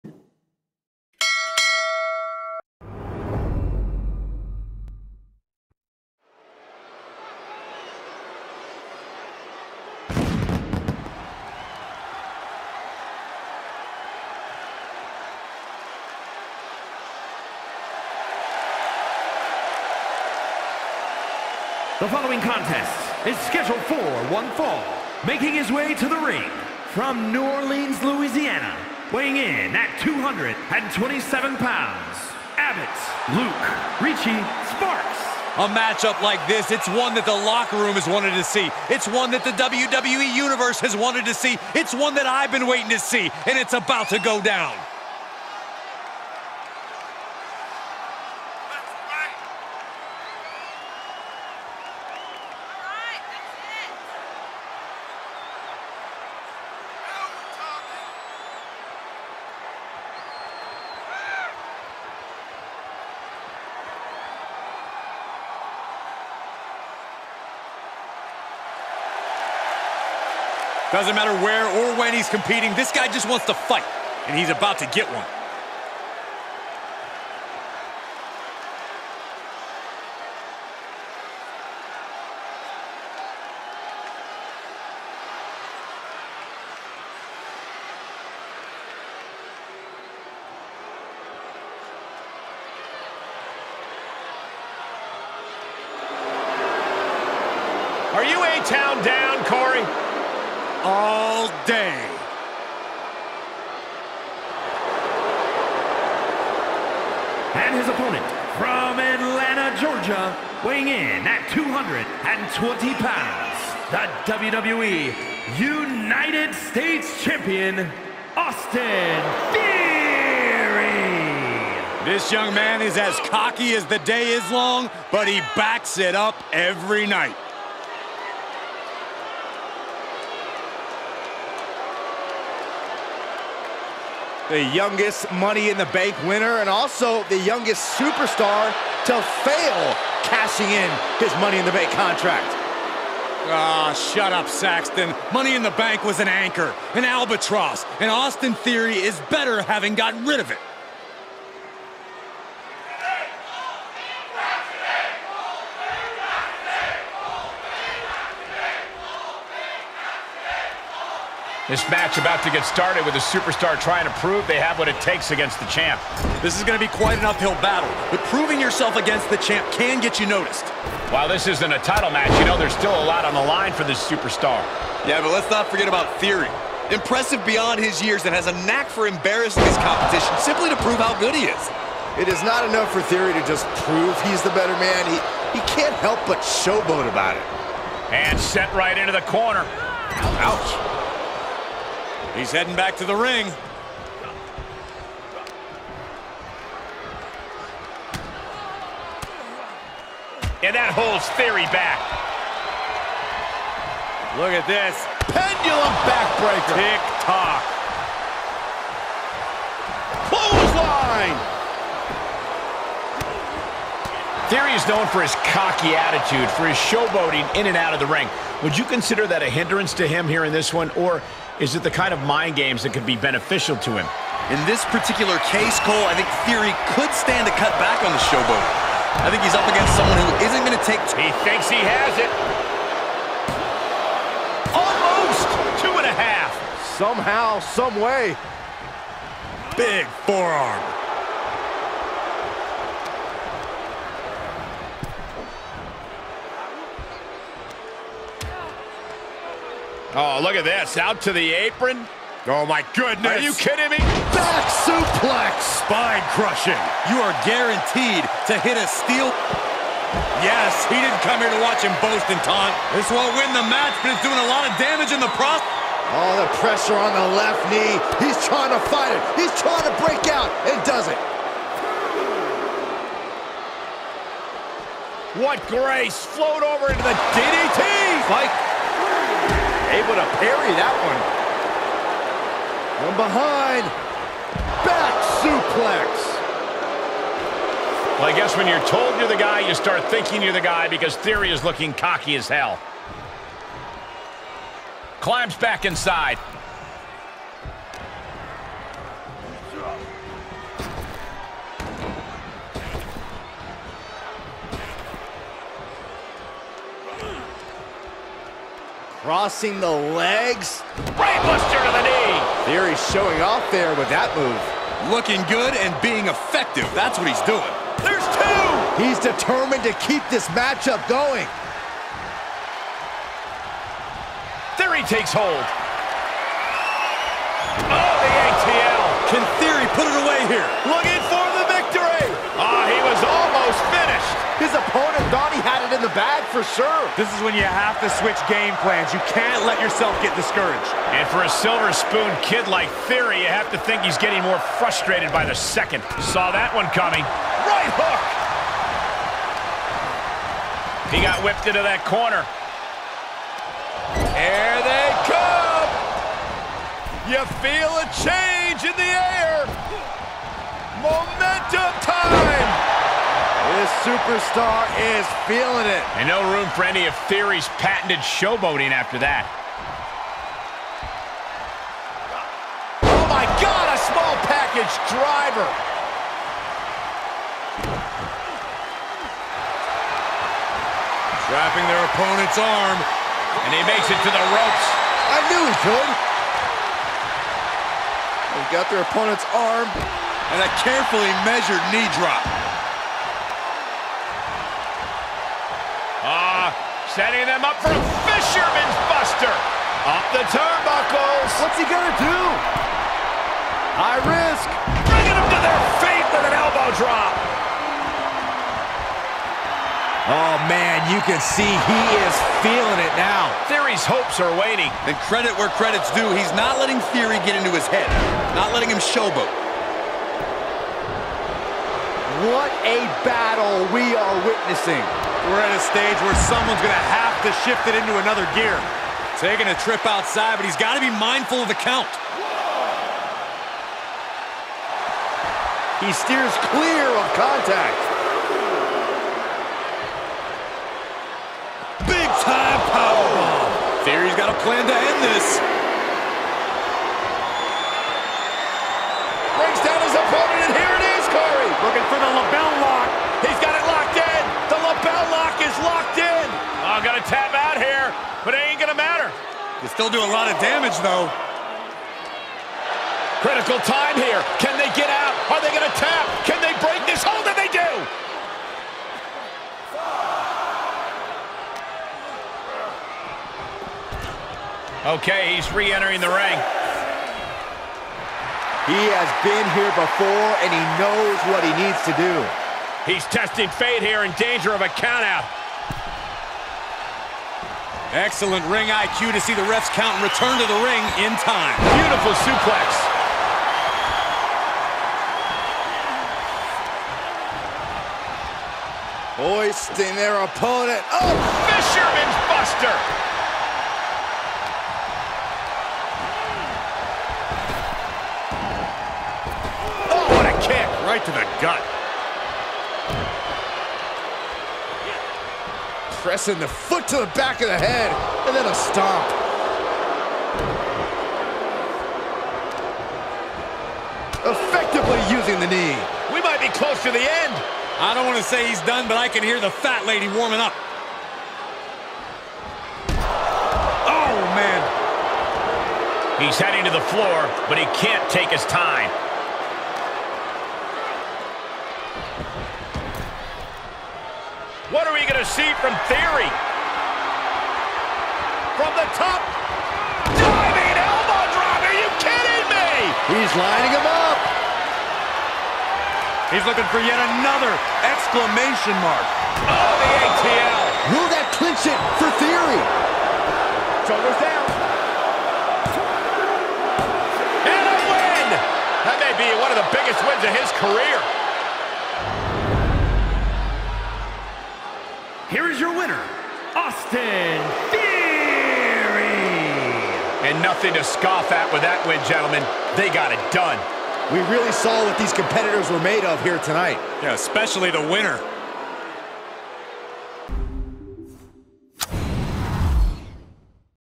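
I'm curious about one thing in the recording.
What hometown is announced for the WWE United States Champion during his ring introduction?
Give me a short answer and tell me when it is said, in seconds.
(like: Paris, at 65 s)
Atlanta, Georgia, at 108 s.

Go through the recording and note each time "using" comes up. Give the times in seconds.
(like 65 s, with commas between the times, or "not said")
525 s.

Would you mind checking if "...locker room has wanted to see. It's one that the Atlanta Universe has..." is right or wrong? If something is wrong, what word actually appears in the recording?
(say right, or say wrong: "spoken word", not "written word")
wrong: "WWE", not "Atlanta".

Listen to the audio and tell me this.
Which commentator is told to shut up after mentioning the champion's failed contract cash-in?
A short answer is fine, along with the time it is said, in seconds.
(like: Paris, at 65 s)
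Saxton, at 144 s.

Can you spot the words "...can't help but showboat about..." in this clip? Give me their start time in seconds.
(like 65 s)
185 s.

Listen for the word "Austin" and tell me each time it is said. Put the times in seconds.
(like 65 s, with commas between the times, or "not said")
118 s, 148 s, 576 s.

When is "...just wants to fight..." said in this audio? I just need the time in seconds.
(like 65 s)
73 s.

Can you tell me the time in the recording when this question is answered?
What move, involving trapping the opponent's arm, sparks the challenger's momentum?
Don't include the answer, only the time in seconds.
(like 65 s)
374 s.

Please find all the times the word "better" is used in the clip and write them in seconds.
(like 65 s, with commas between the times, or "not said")
149 s, 184 s.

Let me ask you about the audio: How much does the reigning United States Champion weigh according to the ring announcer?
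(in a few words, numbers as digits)
220 pounds.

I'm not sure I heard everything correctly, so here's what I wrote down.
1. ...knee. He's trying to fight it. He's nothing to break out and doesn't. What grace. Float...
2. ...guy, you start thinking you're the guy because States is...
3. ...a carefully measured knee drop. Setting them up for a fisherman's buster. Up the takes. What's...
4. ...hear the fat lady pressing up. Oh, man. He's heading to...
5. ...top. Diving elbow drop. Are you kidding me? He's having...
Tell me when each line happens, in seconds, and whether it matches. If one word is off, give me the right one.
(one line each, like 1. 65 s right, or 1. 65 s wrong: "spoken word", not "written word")
1. 267 s wrong: "trying", not "nothing"
2. 289 s wrong: "Theory", not "States"
3. 390 s wrong: "turnbuckles", not "takes"
4. 529 s wrong: "warming", not "pressing"
5. 549 s wrong: "lining", not "having".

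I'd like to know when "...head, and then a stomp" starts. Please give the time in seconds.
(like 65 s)
517 s.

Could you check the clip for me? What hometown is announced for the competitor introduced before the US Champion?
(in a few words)
New Orleans, Louisiana.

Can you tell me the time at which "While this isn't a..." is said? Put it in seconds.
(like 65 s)
171 s.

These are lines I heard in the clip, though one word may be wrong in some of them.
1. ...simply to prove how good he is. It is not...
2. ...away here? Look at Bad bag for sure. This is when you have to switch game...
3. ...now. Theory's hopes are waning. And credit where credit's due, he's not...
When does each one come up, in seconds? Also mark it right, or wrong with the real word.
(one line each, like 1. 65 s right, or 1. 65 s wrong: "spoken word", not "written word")
1. 180 s right
2. 330 s right
3. 413 s right.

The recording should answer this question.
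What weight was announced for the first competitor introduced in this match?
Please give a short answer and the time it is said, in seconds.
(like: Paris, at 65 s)
227 pounds, at 29 s.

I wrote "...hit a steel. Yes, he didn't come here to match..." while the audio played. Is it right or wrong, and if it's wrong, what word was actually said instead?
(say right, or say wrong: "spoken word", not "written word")
wrong: "watch", not "match".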